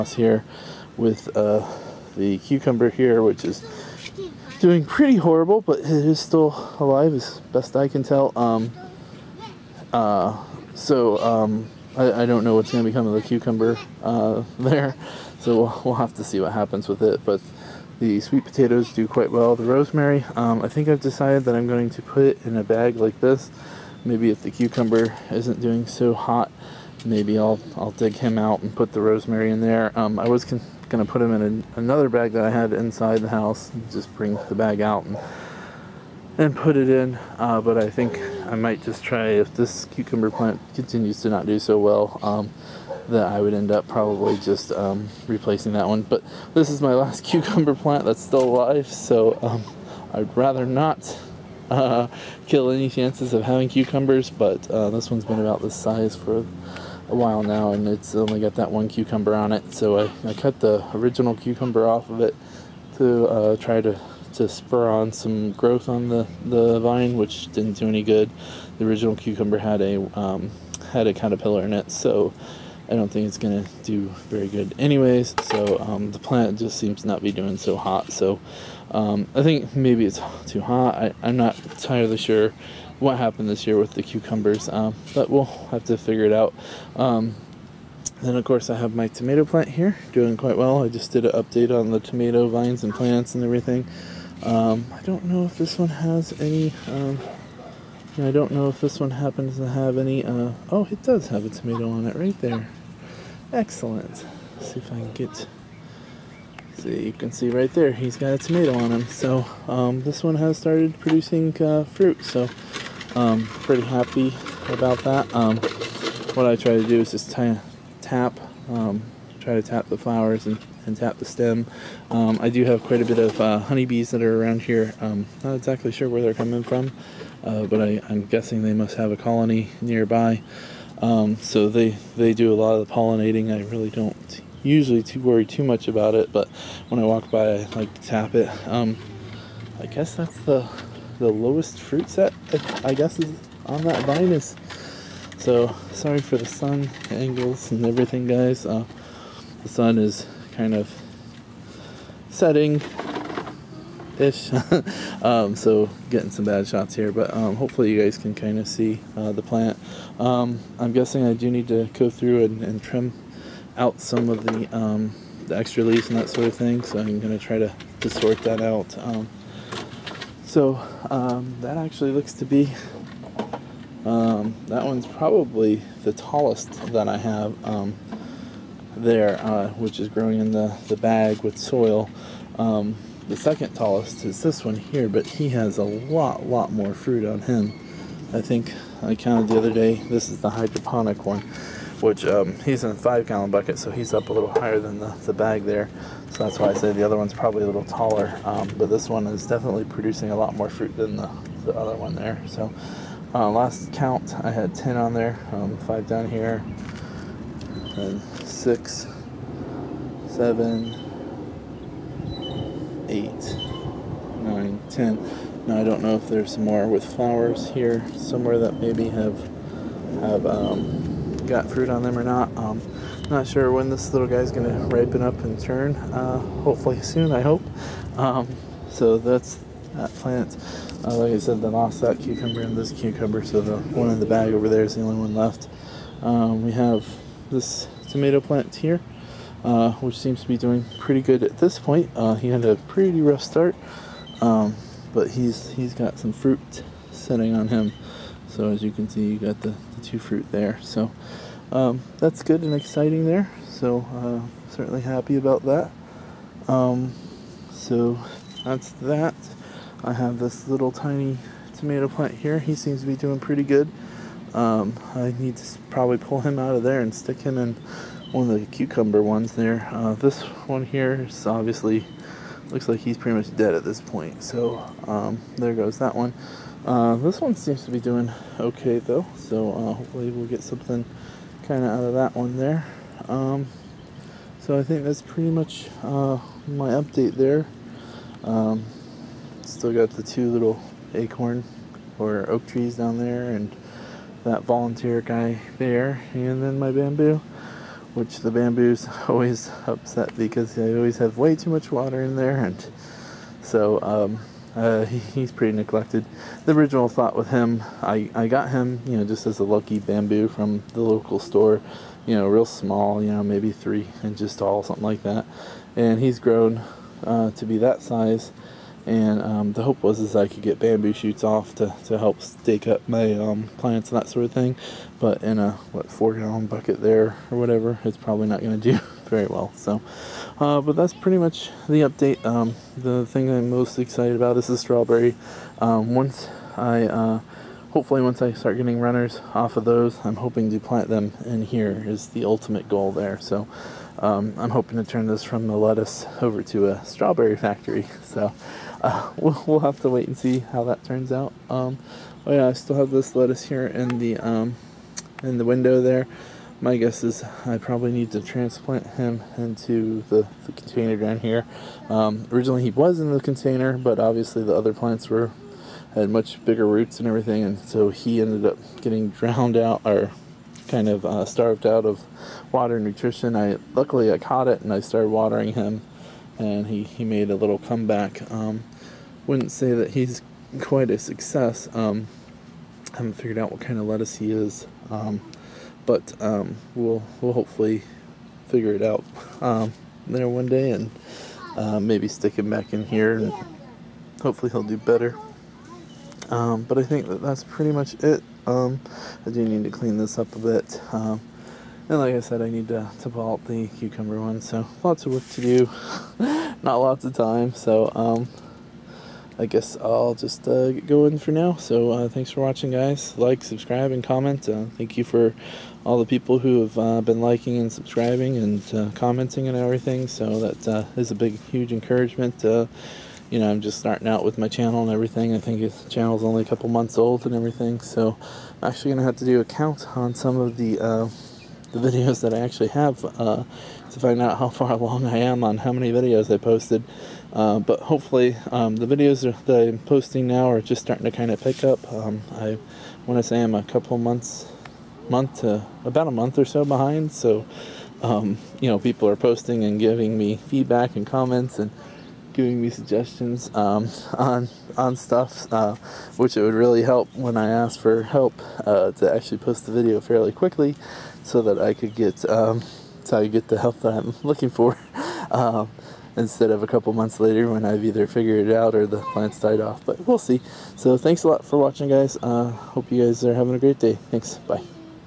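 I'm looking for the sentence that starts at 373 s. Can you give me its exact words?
I luckily I caught it and I started watering him, and he he made a little comeback.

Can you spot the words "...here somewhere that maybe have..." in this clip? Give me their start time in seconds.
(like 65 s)
217 s.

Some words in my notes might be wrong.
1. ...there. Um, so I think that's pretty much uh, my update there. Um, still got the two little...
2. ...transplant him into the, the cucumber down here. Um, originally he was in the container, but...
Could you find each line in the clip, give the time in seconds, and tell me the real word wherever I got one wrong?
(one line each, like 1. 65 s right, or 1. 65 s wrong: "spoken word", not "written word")
1. 282 s right
2. 358 s wrong: "container", not "cucumber".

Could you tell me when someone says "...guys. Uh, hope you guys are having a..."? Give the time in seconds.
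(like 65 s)
472 s.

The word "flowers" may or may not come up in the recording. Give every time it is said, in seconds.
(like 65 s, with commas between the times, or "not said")
119 s, 217 s.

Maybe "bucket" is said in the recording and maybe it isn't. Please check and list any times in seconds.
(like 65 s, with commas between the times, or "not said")
193 s, 326 s.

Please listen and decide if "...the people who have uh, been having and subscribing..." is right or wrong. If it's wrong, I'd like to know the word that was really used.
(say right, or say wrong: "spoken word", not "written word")
wrong: "liking", not "having".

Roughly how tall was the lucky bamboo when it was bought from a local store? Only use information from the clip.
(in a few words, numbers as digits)
3 inches.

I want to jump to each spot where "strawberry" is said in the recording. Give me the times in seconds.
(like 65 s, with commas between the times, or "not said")
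334 s, 347 s.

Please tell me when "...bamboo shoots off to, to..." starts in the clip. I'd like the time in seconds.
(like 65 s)
320 s.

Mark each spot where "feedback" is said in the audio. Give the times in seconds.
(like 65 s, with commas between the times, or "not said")
450 s.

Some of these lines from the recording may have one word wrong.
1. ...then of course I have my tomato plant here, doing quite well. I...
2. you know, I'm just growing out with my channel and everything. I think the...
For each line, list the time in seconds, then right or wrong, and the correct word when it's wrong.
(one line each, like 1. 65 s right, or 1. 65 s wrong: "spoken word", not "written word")
1. 88 s right
2. 422 s wrong: "starting", not "growing".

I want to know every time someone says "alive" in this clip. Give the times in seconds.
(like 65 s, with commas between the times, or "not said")
6 s, 48 s.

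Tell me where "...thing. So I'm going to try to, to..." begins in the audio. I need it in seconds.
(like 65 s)
166 s.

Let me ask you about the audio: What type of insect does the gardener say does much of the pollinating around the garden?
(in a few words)
Honeybees.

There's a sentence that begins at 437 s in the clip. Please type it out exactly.
Uh, but hopefully um, the videos that I'm posting now are just starting to kind of pick up.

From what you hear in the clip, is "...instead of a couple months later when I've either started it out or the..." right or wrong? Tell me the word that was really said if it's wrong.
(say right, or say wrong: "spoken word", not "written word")
wrong: "figured", not "started".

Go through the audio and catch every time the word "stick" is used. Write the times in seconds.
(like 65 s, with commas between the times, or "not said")
267 s, 392 s.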